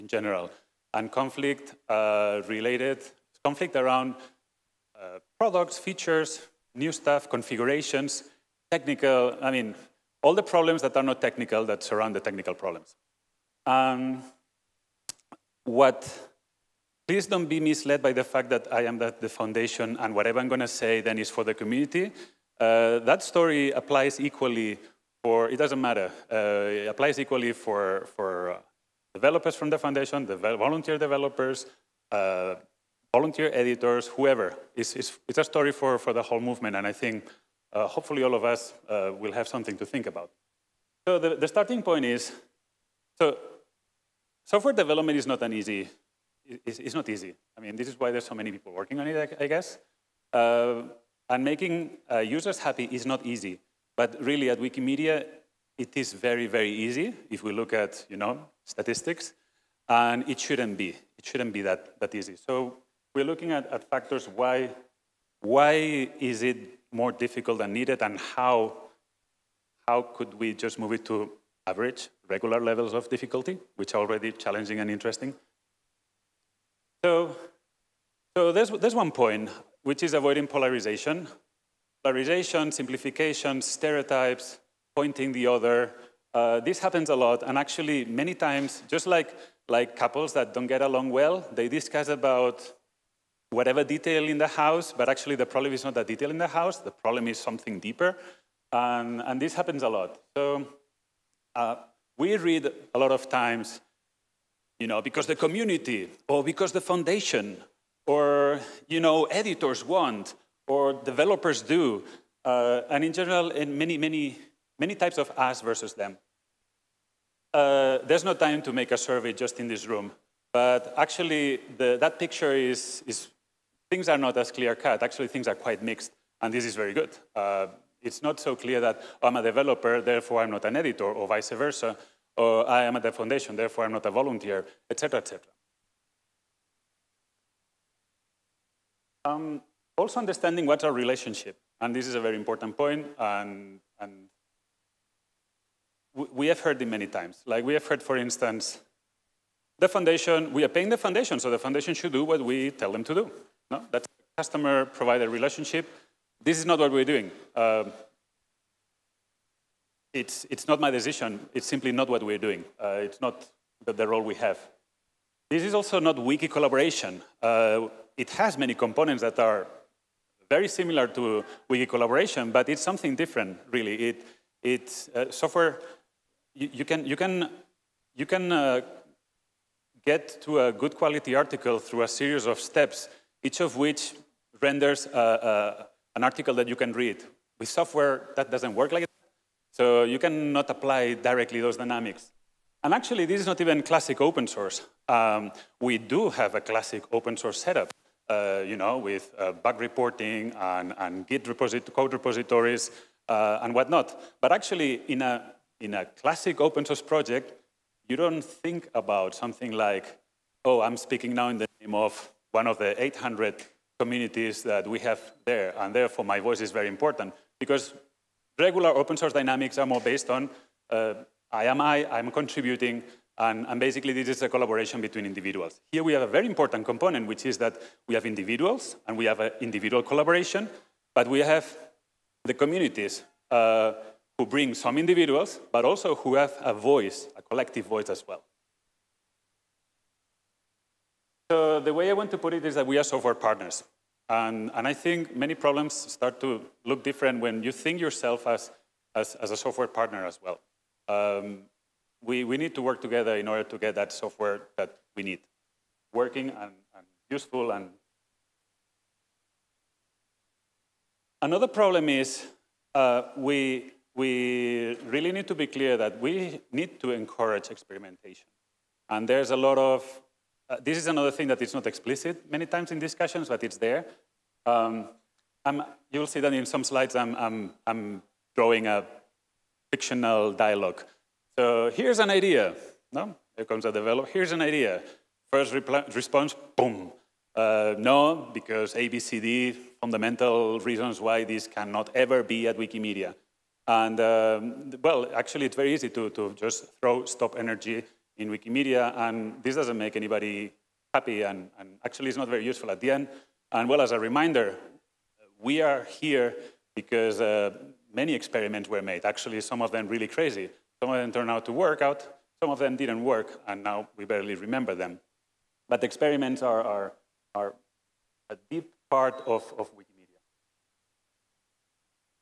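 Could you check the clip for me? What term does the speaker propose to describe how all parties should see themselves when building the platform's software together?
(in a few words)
software partners.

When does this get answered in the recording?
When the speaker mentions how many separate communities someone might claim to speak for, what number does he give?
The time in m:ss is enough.
3:33.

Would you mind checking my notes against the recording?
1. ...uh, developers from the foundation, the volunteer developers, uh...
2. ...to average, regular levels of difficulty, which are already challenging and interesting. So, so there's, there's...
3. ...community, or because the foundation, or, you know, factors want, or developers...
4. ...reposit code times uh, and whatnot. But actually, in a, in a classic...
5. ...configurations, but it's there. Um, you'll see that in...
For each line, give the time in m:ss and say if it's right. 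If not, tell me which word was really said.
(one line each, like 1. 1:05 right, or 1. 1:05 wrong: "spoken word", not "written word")
1. 0:28 right
2. 1:11 right
3. 1:45 wrong: "editors", not "factors"
4. 3:21 wrong: "repositories", not "times"
5. 4:32 wrong: "discussions", not "configurations".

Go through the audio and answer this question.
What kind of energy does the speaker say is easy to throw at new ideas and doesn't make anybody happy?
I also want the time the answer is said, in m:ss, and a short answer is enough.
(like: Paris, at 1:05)
stop energy, at 4:57.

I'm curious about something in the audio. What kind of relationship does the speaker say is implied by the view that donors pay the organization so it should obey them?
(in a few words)
customer-provider relationship.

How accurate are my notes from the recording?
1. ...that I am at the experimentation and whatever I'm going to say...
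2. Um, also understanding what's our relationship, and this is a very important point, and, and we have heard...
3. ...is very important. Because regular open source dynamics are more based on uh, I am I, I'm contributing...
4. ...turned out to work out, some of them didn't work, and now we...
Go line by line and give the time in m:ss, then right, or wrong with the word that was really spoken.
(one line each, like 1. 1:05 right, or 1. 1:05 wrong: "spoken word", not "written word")
1. 0:18 wrong: "foundation", not "experimentation"
2. 2:19 right
3. 3:36 right
4. 5:11 right.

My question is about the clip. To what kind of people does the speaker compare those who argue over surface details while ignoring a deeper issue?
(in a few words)
couples.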